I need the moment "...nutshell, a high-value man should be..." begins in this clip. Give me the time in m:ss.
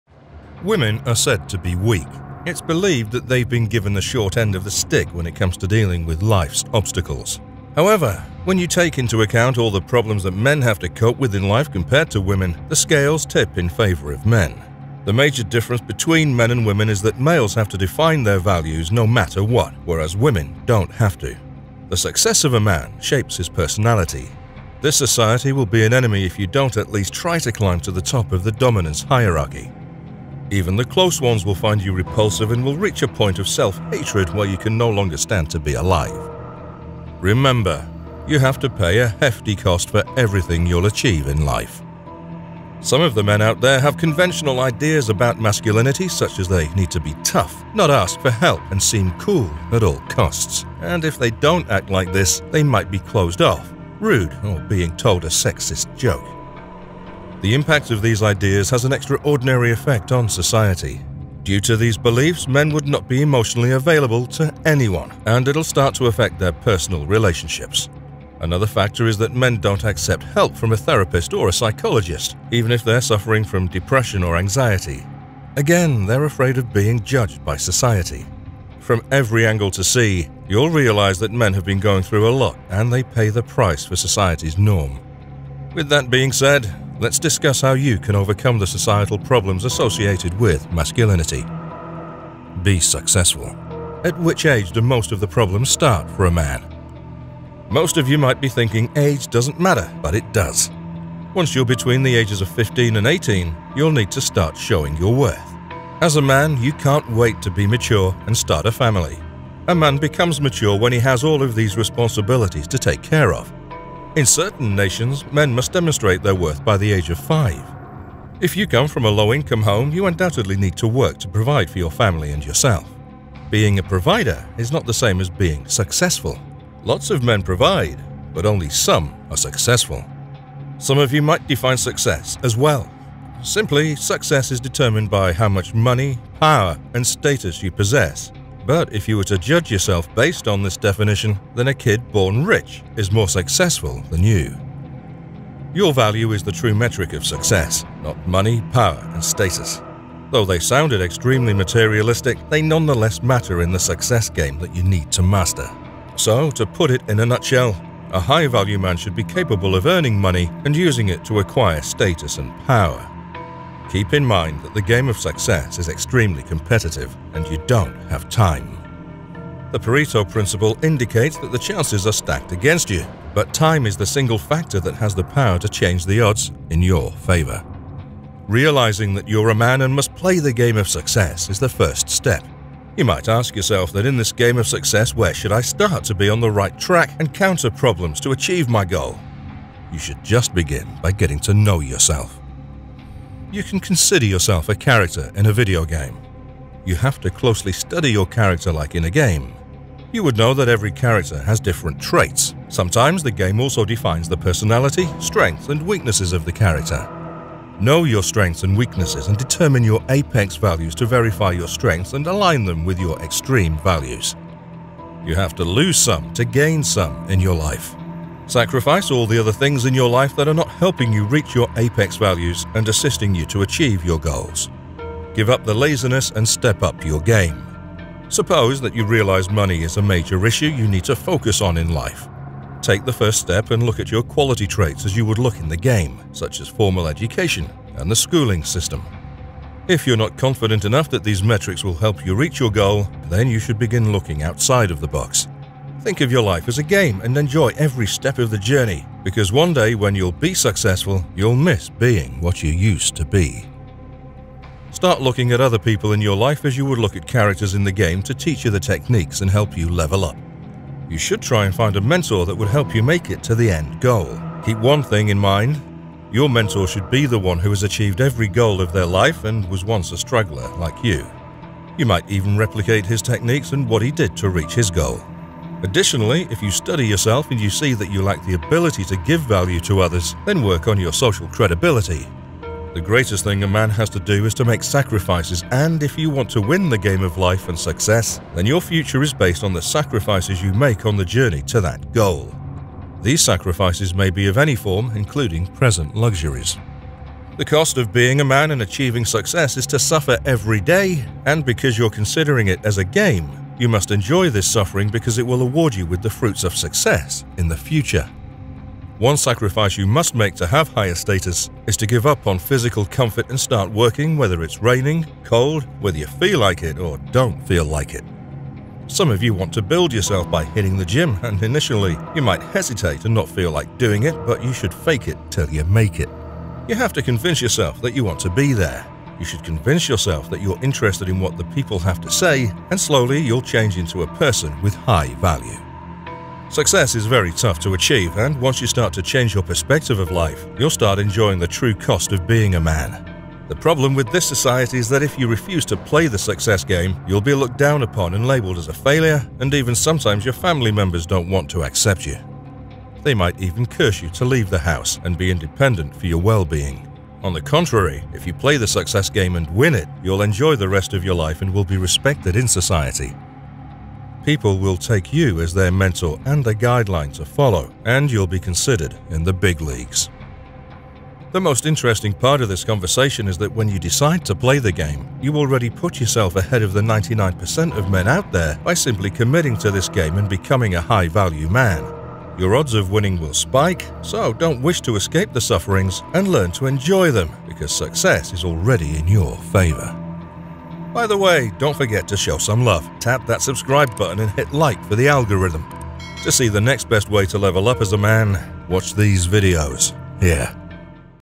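2:37.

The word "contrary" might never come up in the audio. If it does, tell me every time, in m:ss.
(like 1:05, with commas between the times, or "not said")
5:57.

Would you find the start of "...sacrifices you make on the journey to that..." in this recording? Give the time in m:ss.
4:49.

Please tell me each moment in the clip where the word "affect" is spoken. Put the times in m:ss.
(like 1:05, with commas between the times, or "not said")
1:06.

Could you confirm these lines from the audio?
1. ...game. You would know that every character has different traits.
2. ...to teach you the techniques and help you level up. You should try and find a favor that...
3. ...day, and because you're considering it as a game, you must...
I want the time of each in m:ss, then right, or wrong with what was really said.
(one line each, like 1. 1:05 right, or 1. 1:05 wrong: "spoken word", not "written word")
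1. 3:19 right
2. 4:18 wrong: "mentor", not "favor"
3. 5:00 right.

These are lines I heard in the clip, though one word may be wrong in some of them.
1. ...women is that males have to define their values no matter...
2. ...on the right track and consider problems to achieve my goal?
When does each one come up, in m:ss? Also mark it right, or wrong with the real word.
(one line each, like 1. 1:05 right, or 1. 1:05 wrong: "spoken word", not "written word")
1. 0:16 right
2. 3:06 wrong: "counter", not "consider".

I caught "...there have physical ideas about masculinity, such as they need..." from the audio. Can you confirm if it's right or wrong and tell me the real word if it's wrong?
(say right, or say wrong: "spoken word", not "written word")
wrong: "conventional", not "physical".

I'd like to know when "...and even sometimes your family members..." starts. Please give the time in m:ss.
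5:49.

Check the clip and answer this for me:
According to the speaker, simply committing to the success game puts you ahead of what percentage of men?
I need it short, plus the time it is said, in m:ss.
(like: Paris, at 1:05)
99%, at 6:17.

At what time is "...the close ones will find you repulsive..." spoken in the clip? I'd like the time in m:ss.
0:30.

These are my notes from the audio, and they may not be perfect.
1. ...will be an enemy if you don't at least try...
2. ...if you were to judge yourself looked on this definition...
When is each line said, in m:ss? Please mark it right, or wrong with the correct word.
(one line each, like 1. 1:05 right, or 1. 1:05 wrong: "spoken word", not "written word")
1. 0:25 right
2. 2:18 wrong: "based", not "looked".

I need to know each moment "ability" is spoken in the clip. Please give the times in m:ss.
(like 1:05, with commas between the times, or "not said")
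4:38.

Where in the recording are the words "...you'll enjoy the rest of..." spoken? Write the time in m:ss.
6:00.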